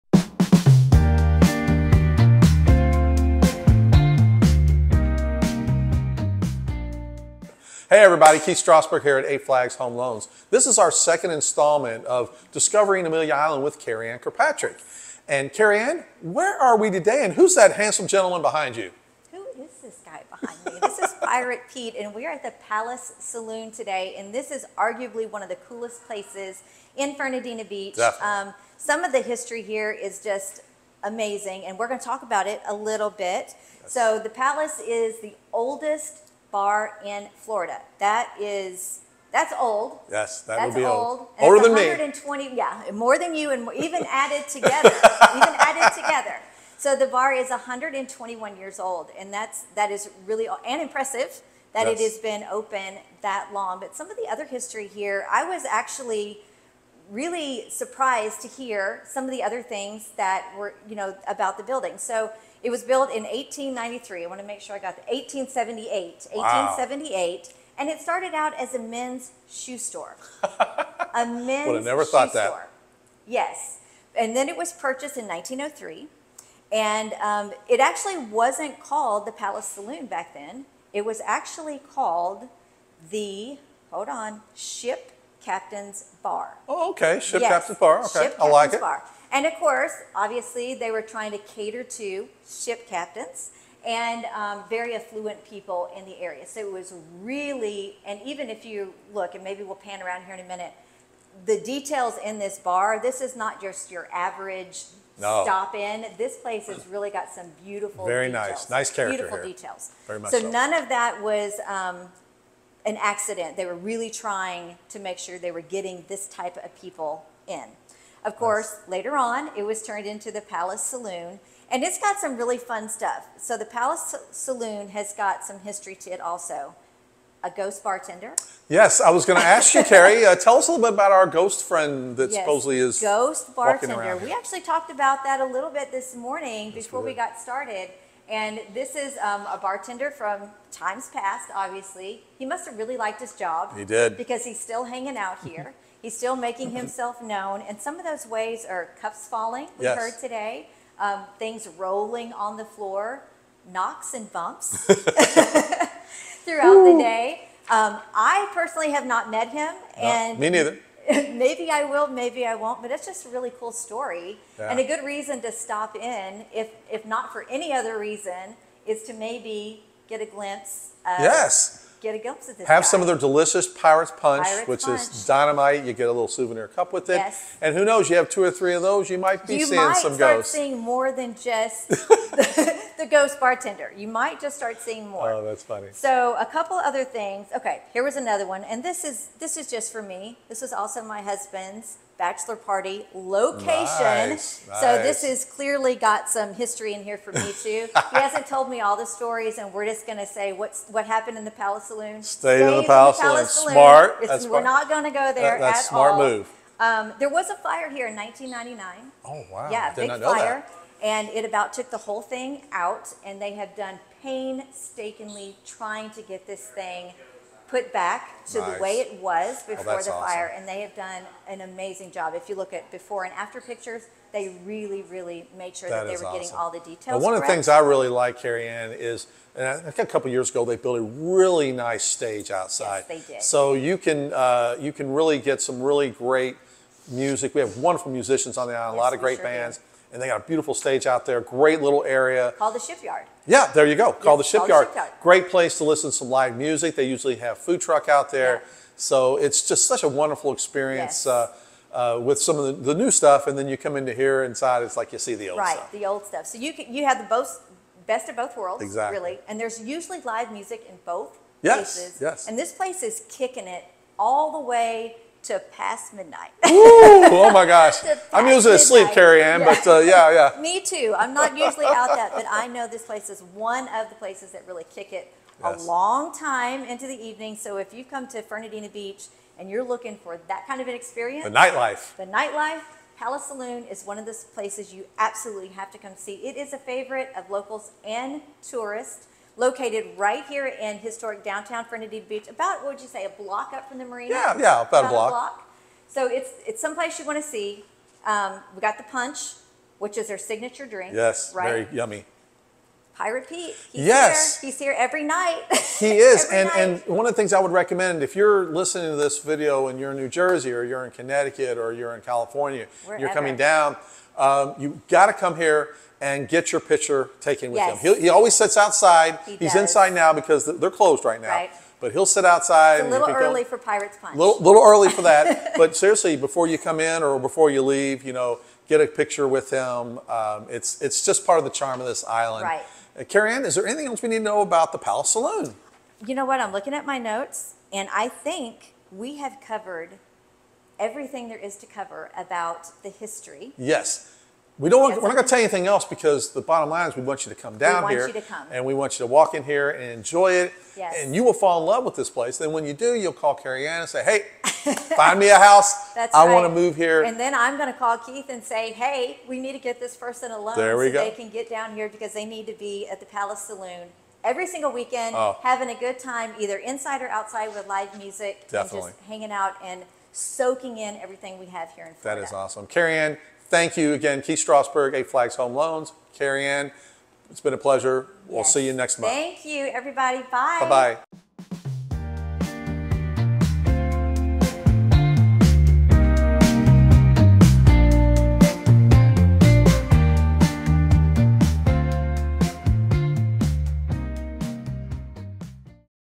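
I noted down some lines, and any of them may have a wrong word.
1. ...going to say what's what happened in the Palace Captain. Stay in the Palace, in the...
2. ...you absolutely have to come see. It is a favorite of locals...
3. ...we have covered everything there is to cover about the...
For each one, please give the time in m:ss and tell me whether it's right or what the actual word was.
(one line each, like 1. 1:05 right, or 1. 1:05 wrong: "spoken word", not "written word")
1. 3:20 wrong: "Saloon", not "Captain"
2. 4:44 right
3. 5:39 right.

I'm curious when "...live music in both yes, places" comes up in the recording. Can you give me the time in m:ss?
4:20.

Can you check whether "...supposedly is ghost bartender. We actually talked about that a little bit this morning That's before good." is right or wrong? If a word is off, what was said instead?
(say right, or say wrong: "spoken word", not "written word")
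right.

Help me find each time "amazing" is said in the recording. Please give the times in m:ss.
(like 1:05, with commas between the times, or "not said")
0:31, 3:41.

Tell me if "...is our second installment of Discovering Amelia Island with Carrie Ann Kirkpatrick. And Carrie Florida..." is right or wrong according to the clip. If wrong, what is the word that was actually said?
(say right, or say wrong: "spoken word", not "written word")
wrong: "Ann", not "Florida".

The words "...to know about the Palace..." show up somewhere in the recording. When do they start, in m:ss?
5:34.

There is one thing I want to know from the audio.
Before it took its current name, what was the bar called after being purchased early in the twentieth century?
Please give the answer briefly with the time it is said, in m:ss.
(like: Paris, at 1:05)
Ship Captain's Bar, at 1:24.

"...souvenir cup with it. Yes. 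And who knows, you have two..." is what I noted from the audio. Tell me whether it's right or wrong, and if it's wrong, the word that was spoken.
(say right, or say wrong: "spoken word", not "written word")
right.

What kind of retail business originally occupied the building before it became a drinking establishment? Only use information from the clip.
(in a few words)
men's shoe store.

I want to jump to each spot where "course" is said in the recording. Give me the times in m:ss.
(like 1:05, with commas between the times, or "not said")
1:29, 1:58.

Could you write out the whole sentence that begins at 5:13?
you're coming down, um, you got to come here and get your picture taken with yes.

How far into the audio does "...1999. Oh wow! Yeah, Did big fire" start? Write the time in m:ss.
3:28.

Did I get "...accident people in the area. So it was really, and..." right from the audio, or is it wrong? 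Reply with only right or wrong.
wrong.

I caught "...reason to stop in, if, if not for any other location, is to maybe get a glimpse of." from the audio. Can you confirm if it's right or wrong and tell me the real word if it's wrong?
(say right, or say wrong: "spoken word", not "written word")
wrong: "reason", not "location".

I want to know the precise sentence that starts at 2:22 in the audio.
He must have really liked his job.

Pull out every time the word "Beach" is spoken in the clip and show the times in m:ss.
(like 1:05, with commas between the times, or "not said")
0:27, 4:38, 4:52.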